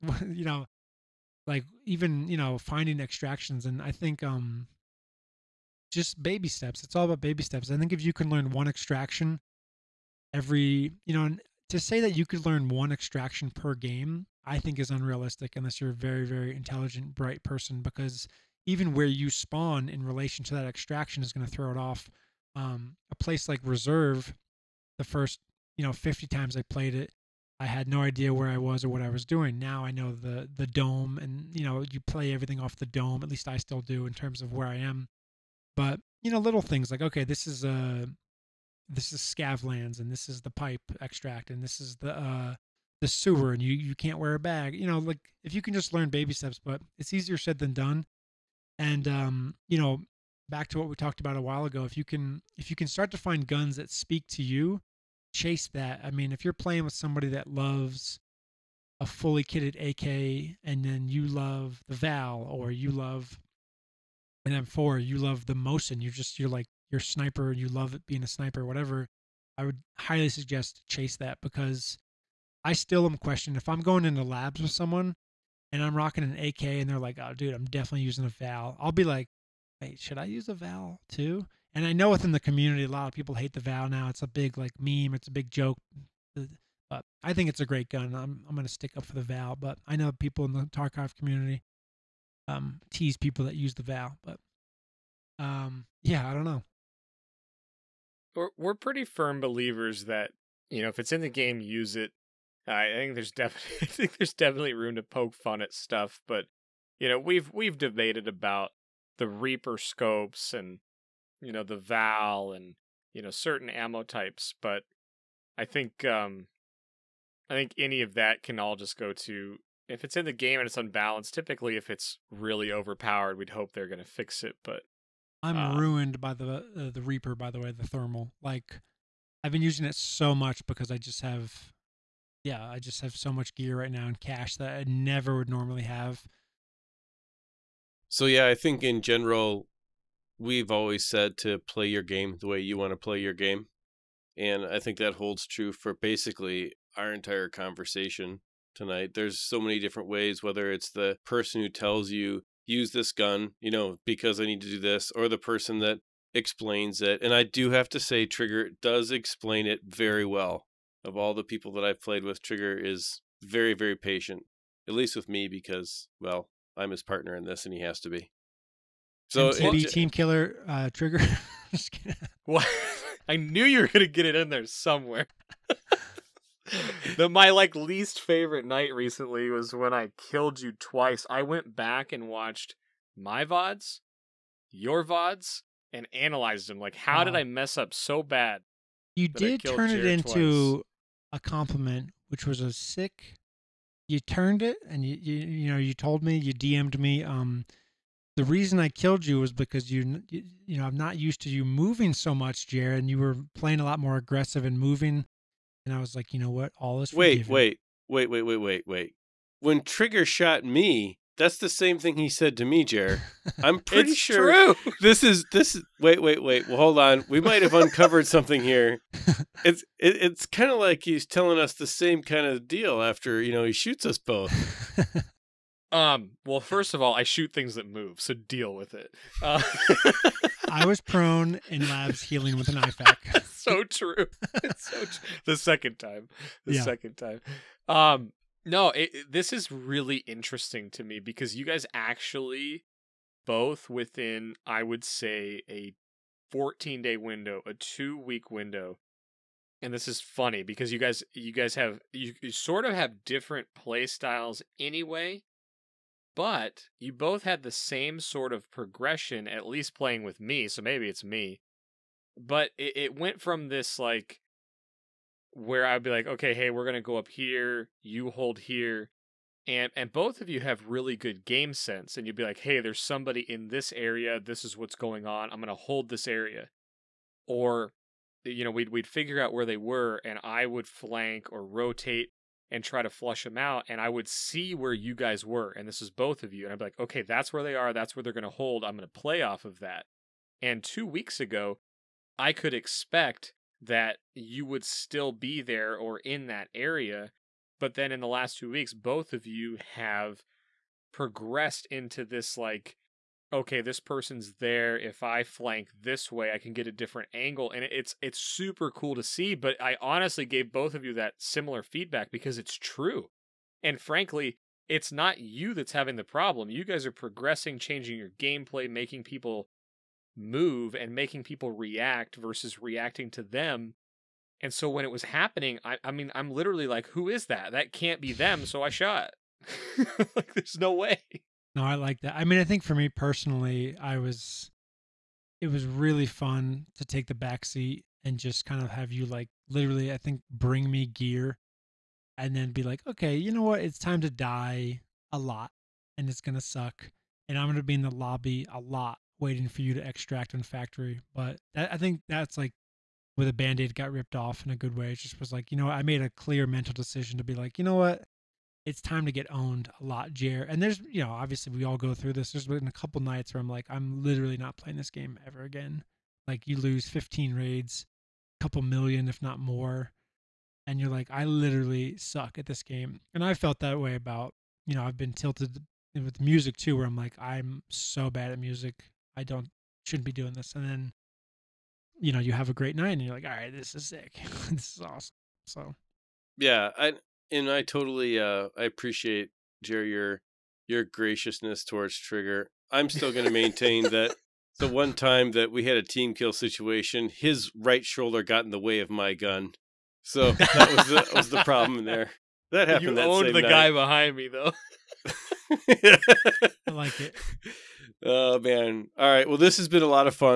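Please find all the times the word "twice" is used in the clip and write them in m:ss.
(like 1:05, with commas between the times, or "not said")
3:00, 3:10.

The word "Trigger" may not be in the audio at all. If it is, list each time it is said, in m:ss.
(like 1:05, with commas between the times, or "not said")
2:38, 2:42, 2:50, 3:29, 6:32.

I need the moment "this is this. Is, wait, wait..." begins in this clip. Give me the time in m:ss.
3:34.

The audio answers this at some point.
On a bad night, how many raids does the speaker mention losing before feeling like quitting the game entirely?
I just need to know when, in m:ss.
6:07.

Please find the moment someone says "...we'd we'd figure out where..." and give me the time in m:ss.
4:38.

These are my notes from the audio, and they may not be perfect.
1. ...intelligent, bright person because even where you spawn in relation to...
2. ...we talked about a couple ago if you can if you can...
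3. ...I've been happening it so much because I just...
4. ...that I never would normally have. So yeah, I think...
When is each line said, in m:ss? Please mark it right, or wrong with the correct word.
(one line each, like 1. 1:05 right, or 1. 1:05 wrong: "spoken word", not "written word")
1. 0:16 right
2. 0:50 wrong: "while", not "couple"
3. 2:09 wrong: "using", not "happening"
4. 2:14 right.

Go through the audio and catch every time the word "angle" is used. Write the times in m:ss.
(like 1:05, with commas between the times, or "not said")
5:07.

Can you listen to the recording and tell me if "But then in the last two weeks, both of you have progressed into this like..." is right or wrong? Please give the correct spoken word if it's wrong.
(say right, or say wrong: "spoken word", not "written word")
right.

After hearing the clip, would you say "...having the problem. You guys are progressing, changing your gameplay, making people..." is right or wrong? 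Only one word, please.
right.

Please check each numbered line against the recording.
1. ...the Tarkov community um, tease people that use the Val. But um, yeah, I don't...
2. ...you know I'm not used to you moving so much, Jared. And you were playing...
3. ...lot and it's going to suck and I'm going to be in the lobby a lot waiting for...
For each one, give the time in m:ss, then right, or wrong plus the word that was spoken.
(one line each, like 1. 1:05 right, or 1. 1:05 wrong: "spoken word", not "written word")
1. 1:30 right
2. 3:20 right
3. 5:45 right.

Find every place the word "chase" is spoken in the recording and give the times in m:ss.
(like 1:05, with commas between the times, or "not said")
0:55, 1:10.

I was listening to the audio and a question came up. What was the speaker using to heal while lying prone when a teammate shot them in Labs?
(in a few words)
an IFAK.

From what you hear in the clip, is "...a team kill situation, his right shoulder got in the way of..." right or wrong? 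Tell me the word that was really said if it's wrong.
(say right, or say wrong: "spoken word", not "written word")
right.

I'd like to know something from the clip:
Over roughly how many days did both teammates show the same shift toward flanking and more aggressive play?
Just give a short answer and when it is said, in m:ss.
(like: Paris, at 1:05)
14, at 4:06.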